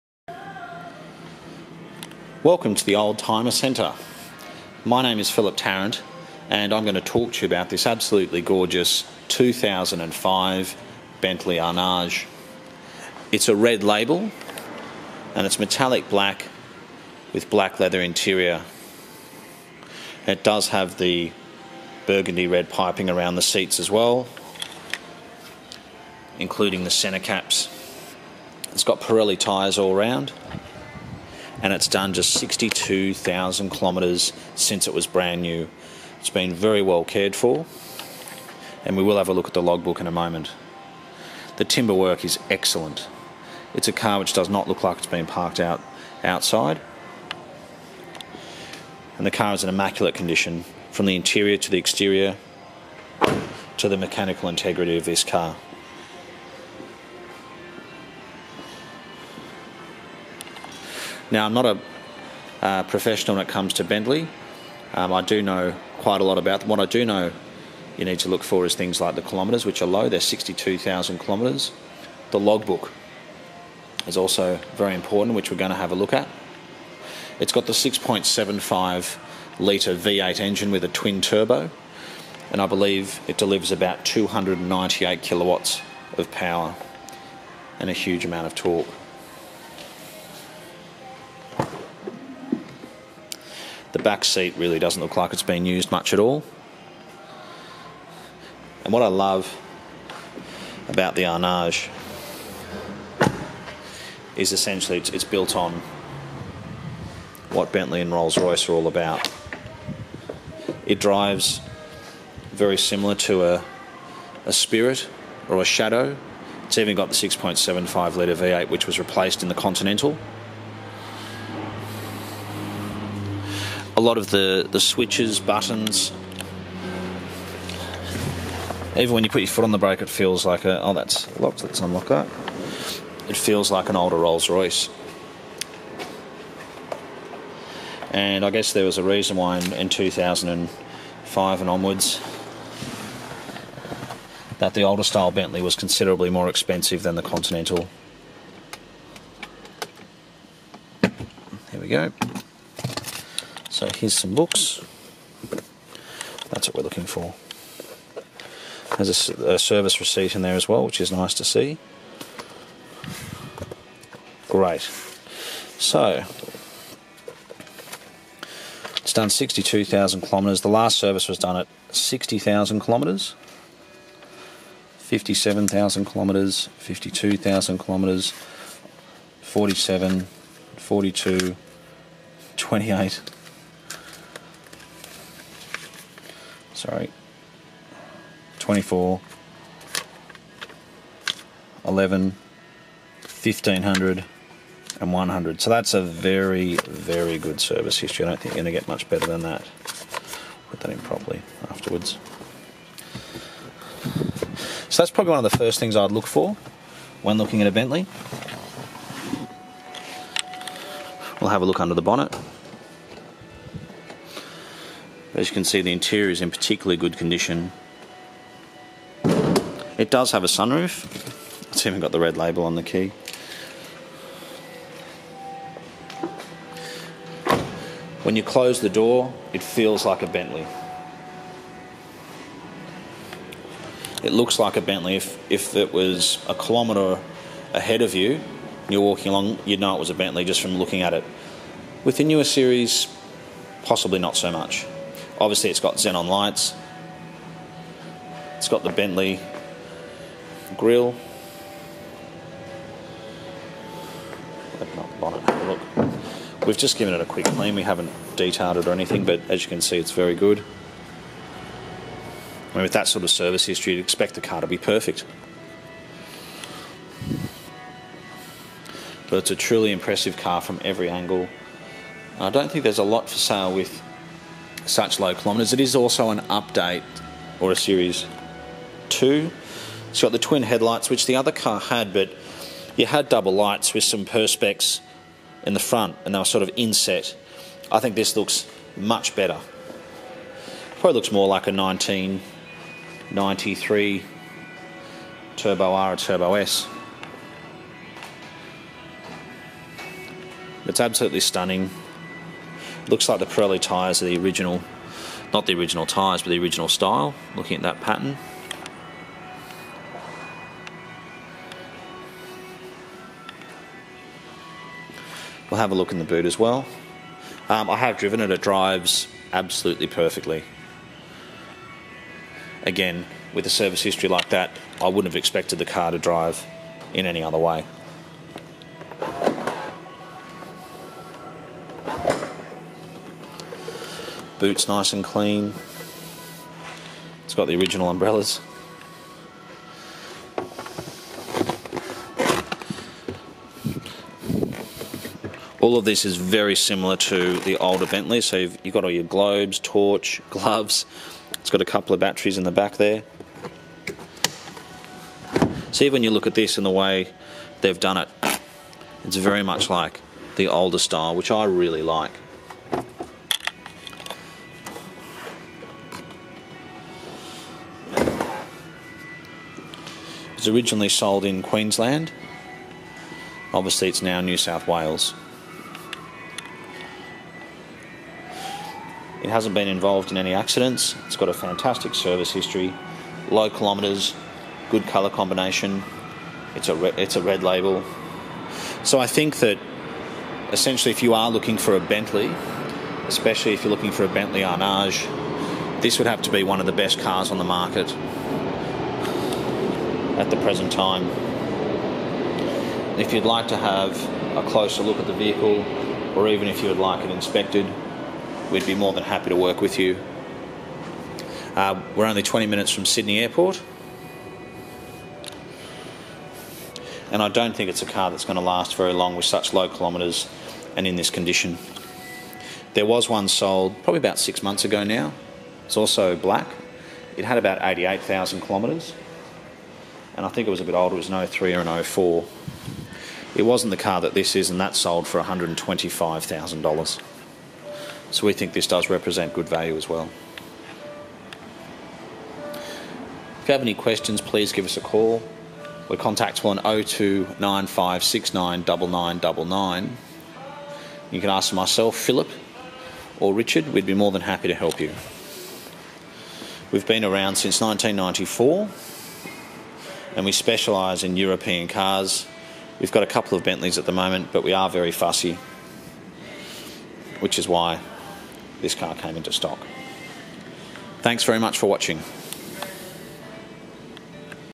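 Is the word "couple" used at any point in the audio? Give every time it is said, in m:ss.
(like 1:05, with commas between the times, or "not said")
5:51, 7:43.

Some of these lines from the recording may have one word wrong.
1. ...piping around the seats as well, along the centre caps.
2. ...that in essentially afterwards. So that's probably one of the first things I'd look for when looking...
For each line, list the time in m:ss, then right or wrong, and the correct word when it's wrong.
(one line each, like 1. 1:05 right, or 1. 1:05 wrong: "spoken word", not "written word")
1. 0:22 wrong: "including", not "along"
2. 3:20 wrong: "properly", not "essentially".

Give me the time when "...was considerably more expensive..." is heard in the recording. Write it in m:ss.
2:25.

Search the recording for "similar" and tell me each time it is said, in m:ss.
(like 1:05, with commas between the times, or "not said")
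1:52, 5:46.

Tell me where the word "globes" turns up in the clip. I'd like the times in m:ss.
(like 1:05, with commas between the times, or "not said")
5:49.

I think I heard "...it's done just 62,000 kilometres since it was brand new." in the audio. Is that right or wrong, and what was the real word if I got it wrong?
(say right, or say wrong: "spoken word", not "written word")
right.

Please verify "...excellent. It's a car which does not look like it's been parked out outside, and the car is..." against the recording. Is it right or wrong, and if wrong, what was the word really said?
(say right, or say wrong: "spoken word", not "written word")
right.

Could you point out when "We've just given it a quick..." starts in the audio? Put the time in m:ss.
4:16.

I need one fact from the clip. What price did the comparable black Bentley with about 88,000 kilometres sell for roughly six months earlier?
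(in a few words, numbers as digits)
$125,000.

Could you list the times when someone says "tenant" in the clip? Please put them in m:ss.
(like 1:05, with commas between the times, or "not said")
not said.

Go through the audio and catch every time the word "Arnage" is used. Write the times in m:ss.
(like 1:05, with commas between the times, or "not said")
0:11, 1:41, 6:34.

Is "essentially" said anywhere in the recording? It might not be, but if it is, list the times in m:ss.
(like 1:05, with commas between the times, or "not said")
1:44, 6:30.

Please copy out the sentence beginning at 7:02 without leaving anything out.
There was one sold probably about six months ago now.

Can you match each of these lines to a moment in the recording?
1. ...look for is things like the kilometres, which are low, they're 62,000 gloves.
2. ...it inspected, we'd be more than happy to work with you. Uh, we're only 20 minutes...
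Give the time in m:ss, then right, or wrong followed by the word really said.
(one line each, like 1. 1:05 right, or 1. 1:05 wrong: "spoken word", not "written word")
1. 1:08 wrong: "kilometres", not "gloves"
2. 6:47 right.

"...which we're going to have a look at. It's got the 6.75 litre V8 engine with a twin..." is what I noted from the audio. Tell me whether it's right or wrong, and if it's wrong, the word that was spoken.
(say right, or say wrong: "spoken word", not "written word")
right.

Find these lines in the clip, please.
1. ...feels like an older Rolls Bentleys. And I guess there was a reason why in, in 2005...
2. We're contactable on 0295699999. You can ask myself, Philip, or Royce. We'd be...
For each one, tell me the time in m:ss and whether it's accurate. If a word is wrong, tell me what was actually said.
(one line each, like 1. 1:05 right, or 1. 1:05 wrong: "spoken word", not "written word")
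1. 2:13 wrong: "Royce", not "Bentleys"
2. 7:26 wrong: "Richard", not "Royce".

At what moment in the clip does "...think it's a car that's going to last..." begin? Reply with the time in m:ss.
6:57.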